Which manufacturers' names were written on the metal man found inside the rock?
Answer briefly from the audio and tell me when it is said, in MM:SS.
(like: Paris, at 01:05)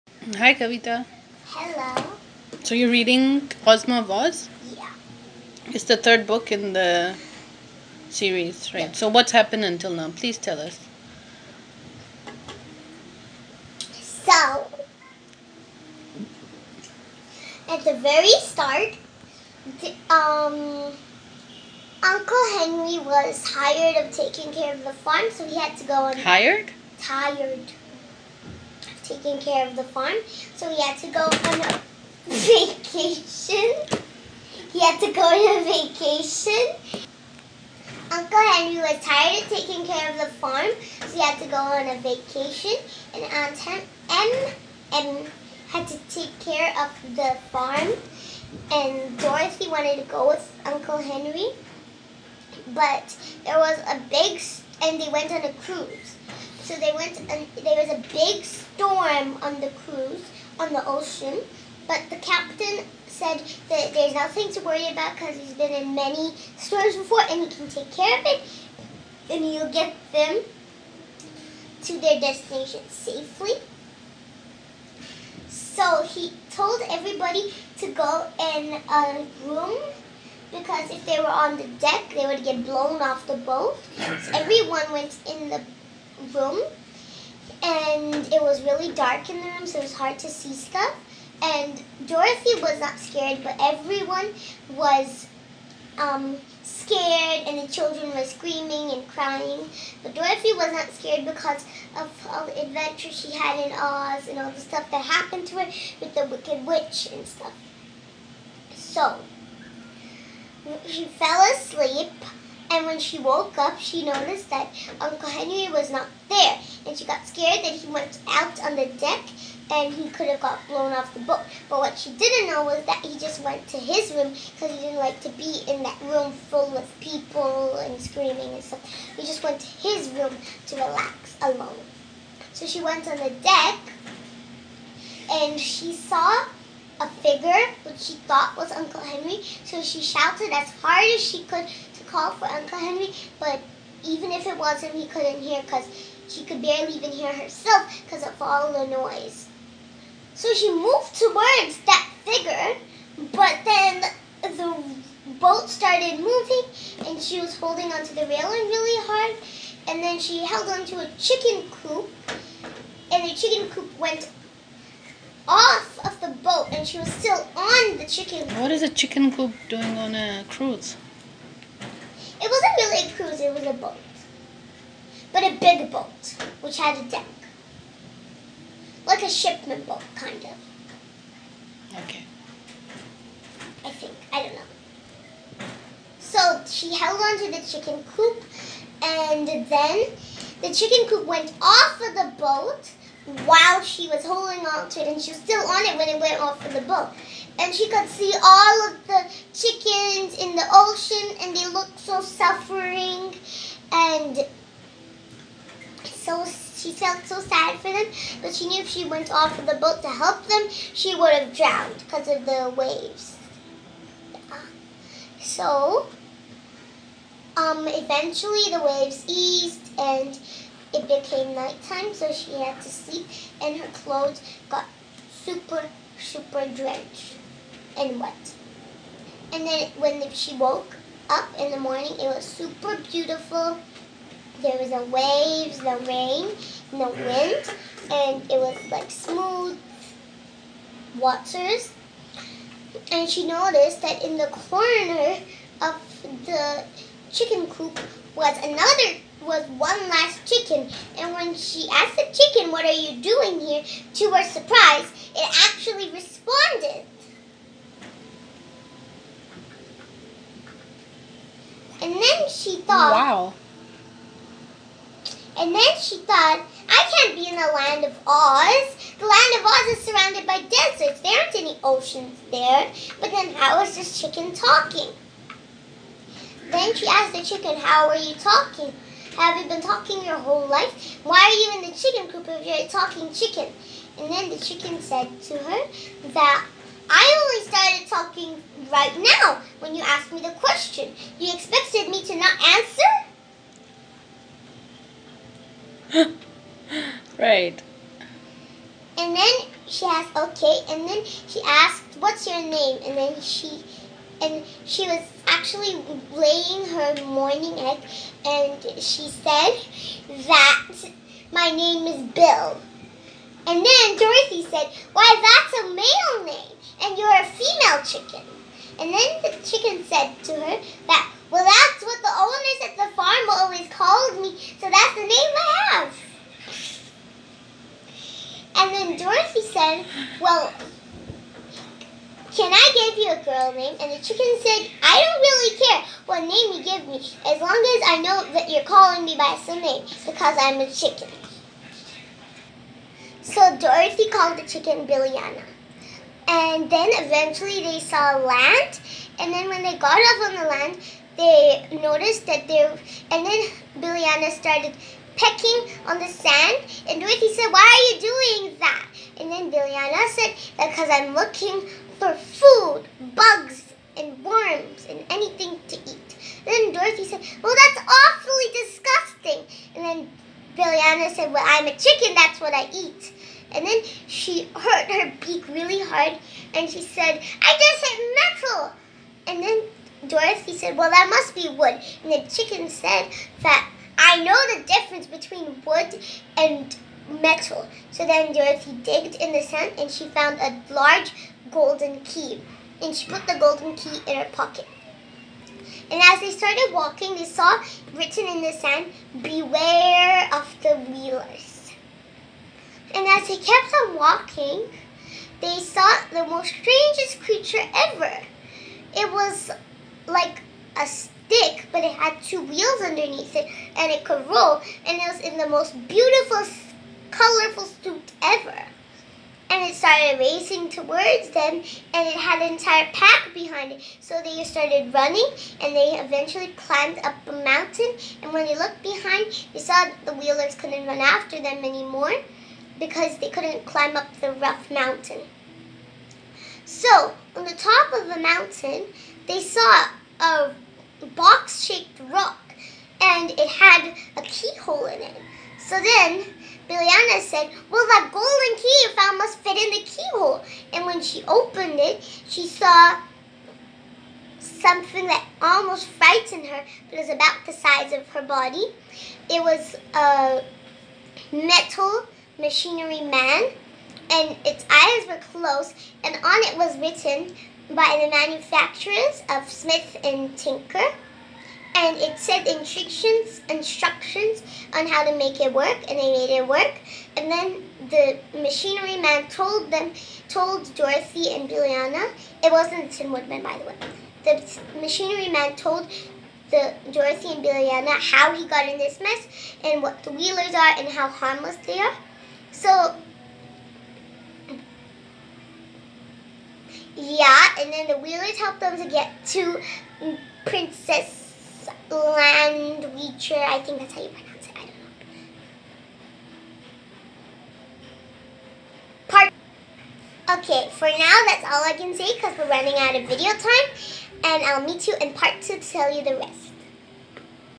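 Smith and Tinker, at 07:49.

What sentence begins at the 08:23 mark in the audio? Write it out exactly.
I think that's how you pronounce it.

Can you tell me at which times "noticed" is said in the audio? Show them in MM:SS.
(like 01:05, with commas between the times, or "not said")
01:54, 04:03, 05:52.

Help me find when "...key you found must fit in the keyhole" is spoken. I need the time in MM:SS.
07:28.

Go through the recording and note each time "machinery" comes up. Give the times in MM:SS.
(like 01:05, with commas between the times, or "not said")
07:42, 07:58, 08:04.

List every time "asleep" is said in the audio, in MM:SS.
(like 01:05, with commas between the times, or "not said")
01:51.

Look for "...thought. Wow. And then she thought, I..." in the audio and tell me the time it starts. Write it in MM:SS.
04:22.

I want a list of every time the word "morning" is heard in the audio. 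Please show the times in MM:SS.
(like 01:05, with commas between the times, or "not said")
03:51, 05:07.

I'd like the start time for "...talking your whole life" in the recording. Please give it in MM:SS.
04:39.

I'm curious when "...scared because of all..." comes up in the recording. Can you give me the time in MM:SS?
01:40.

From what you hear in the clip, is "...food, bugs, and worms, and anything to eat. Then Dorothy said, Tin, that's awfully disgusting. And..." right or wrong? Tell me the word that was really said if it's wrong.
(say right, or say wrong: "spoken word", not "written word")
wrong: "Well", not "Tin".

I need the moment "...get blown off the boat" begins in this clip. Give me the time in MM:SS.
01:22.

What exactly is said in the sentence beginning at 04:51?
You expected me to not answer?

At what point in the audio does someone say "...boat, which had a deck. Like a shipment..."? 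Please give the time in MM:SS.
02:55.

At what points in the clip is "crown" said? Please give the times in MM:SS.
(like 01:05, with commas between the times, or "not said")
not said.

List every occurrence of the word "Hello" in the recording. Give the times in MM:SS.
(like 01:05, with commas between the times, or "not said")
00:01.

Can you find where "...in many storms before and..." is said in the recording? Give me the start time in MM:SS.
01:05.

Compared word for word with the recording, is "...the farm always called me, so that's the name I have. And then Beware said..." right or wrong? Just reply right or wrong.
wrong.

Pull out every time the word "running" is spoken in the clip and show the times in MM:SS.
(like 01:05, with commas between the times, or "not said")
07:05, 08:32.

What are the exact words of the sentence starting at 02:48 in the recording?
What is a chicken coop doing on a cruise?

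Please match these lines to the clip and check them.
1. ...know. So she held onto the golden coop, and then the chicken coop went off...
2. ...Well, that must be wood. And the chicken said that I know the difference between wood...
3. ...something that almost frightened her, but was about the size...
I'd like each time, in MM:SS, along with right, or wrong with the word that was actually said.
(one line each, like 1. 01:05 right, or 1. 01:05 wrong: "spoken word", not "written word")
1. 03:04 wrong: "chicken", not "golden"
2. 06:20 right
3. 07:34 right.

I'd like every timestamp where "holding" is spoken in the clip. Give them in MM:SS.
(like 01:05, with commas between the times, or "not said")
02:37, 03:14.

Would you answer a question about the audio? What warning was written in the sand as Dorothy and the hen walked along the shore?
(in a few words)
Beware of the Wheelers.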